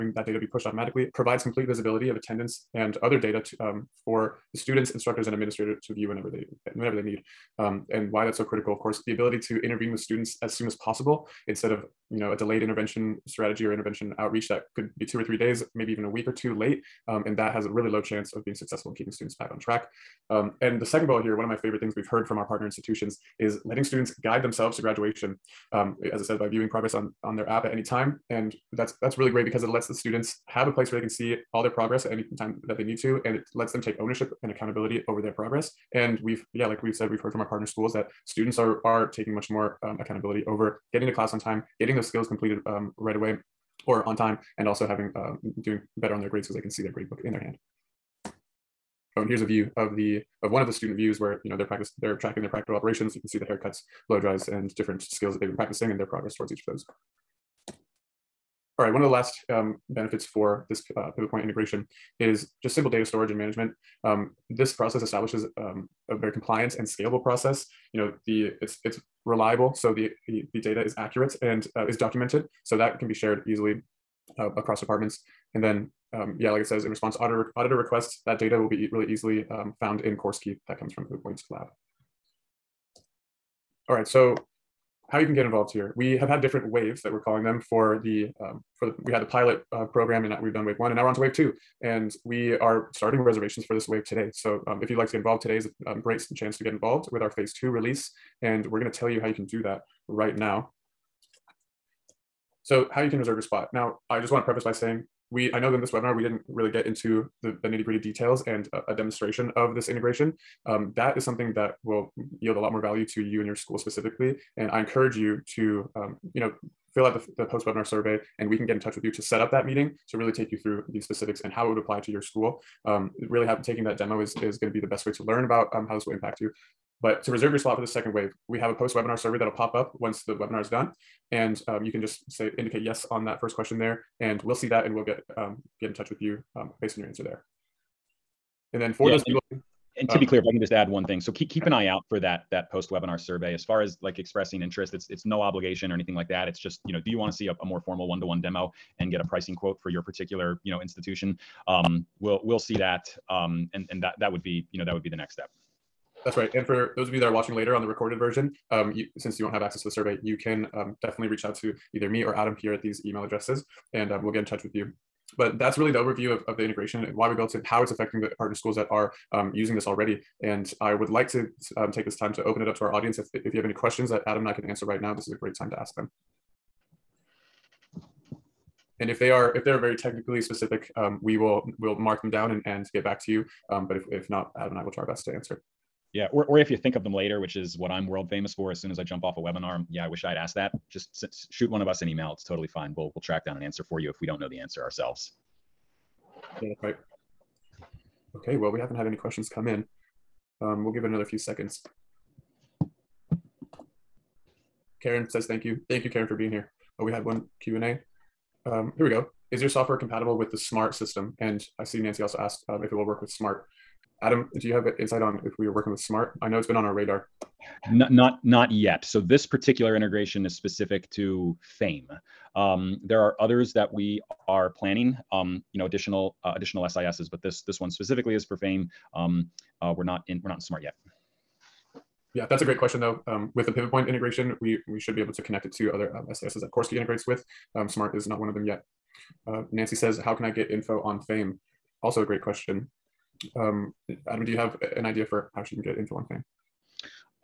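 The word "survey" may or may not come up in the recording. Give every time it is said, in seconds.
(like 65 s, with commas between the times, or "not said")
117 s, 129 s, 143 s, 159 s.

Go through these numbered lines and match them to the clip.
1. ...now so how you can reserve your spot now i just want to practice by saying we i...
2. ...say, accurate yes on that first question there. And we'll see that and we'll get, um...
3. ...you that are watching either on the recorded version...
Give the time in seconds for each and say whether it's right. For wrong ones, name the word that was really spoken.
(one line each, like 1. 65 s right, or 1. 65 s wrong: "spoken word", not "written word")
1. 100 s wrong: "preface", not "practice"
2. 132 s wrong: "indicate", not "accurate"
3. 157 s wrong: "later", not "either".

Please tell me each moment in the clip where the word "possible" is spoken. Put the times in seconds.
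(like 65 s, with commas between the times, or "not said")
10 s.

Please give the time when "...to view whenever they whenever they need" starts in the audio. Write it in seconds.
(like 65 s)
5 s.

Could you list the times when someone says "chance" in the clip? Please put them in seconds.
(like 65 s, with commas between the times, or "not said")
18 s, 96 s.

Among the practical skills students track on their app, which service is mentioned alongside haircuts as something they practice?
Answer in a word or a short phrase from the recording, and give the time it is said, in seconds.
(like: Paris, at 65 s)
blow dries, at 54 s.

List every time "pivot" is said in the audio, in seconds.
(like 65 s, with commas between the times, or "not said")
61 s, 233 s.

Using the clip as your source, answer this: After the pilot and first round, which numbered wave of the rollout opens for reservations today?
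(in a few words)
wave two.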